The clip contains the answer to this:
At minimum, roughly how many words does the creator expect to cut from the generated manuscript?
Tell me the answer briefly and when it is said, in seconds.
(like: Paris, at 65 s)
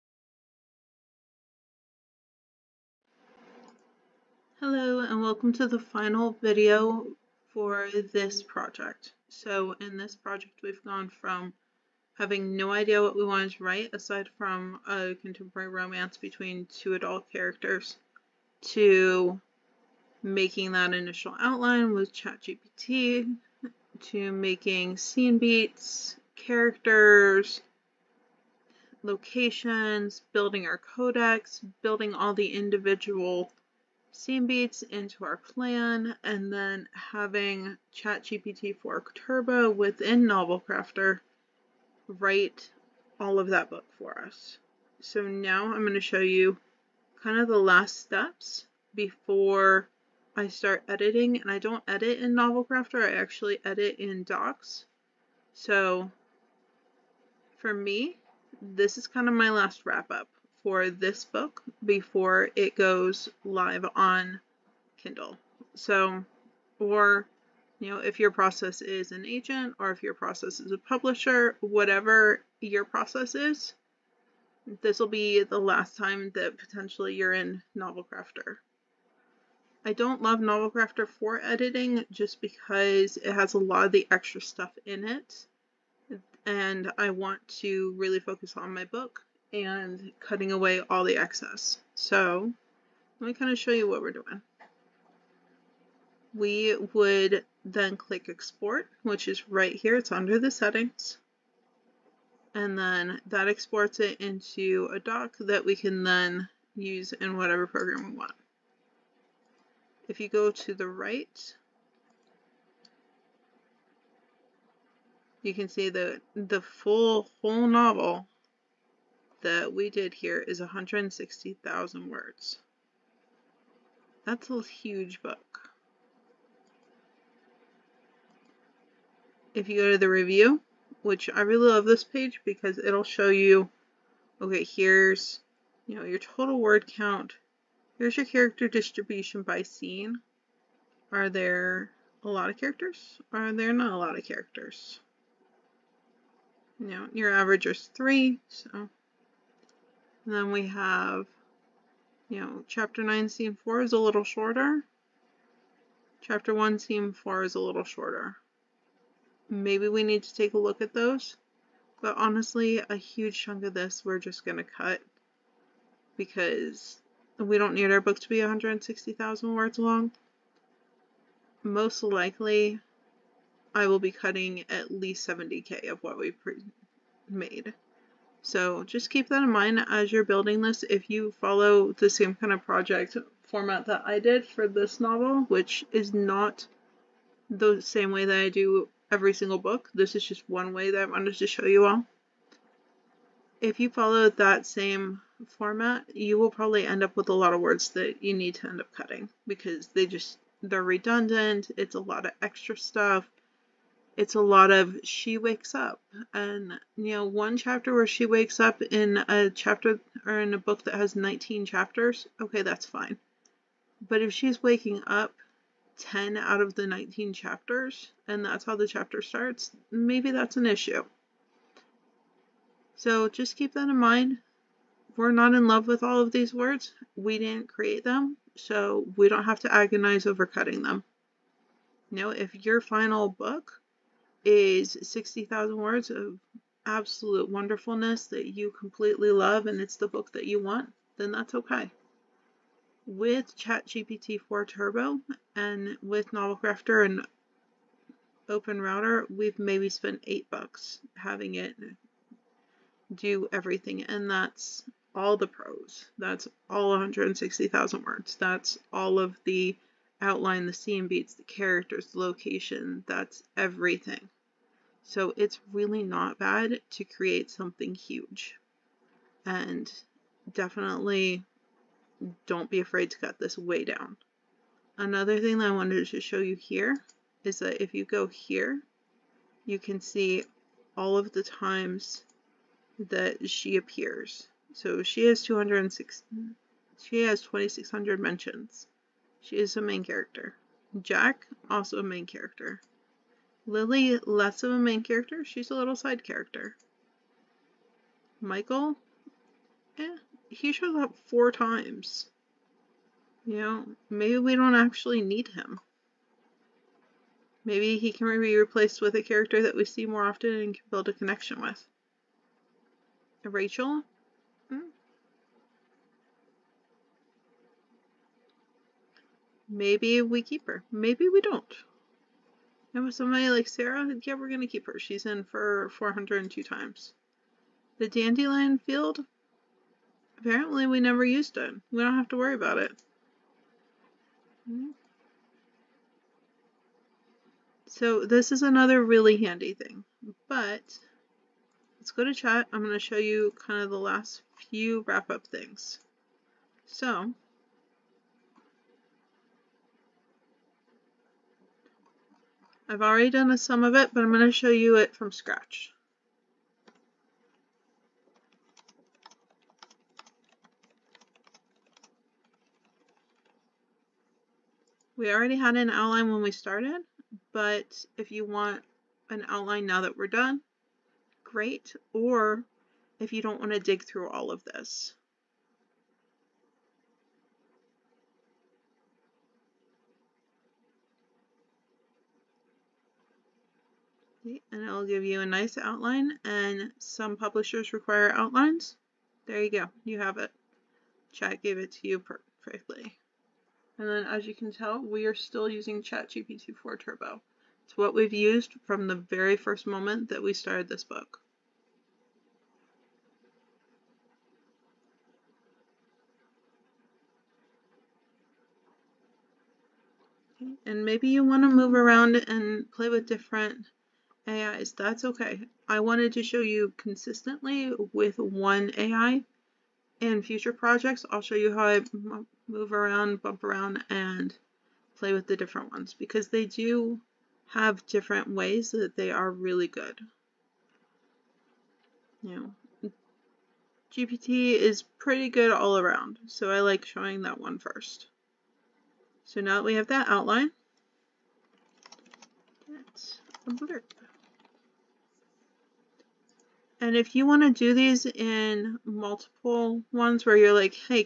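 70k, at 175 s.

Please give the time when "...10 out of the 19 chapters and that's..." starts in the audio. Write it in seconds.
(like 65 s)
215 s.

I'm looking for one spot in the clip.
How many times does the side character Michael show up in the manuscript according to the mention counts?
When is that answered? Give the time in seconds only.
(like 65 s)
301 s.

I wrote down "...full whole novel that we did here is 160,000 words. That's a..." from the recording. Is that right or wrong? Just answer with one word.
right.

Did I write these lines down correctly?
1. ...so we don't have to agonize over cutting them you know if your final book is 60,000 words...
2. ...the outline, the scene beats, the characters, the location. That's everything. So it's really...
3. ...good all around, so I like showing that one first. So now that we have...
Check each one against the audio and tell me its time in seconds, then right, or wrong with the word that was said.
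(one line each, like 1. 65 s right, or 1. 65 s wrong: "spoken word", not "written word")
1. 228 s right
2. 259 s right
3. 435 s right.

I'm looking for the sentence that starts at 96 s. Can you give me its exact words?
We would then click export, which is right here.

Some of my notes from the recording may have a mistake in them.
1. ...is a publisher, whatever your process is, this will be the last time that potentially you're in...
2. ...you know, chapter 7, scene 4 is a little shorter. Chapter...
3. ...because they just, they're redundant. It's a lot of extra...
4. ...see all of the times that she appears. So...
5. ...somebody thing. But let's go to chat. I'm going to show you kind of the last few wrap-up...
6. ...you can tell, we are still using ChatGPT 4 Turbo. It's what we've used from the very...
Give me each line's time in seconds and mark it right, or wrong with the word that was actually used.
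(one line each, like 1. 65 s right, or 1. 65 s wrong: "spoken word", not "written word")
1. 70 s right
2. 152 s wrong: "9", not "7"
3. 199 s right
4. 280 s right
5. 339 s wrong: "handy", not "somebody"
6. 394 s right.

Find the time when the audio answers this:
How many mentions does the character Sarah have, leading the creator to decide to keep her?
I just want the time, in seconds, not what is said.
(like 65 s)
325 s.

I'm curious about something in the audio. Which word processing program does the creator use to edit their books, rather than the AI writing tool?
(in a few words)
Docs.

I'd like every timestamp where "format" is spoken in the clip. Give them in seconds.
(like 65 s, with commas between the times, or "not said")
183 s, 195 s.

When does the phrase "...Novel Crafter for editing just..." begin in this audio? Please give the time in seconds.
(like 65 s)
80 s.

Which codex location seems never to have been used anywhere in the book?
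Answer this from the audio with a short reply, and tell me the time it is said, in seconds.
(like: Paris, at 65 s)
dandelion field, at 328 s.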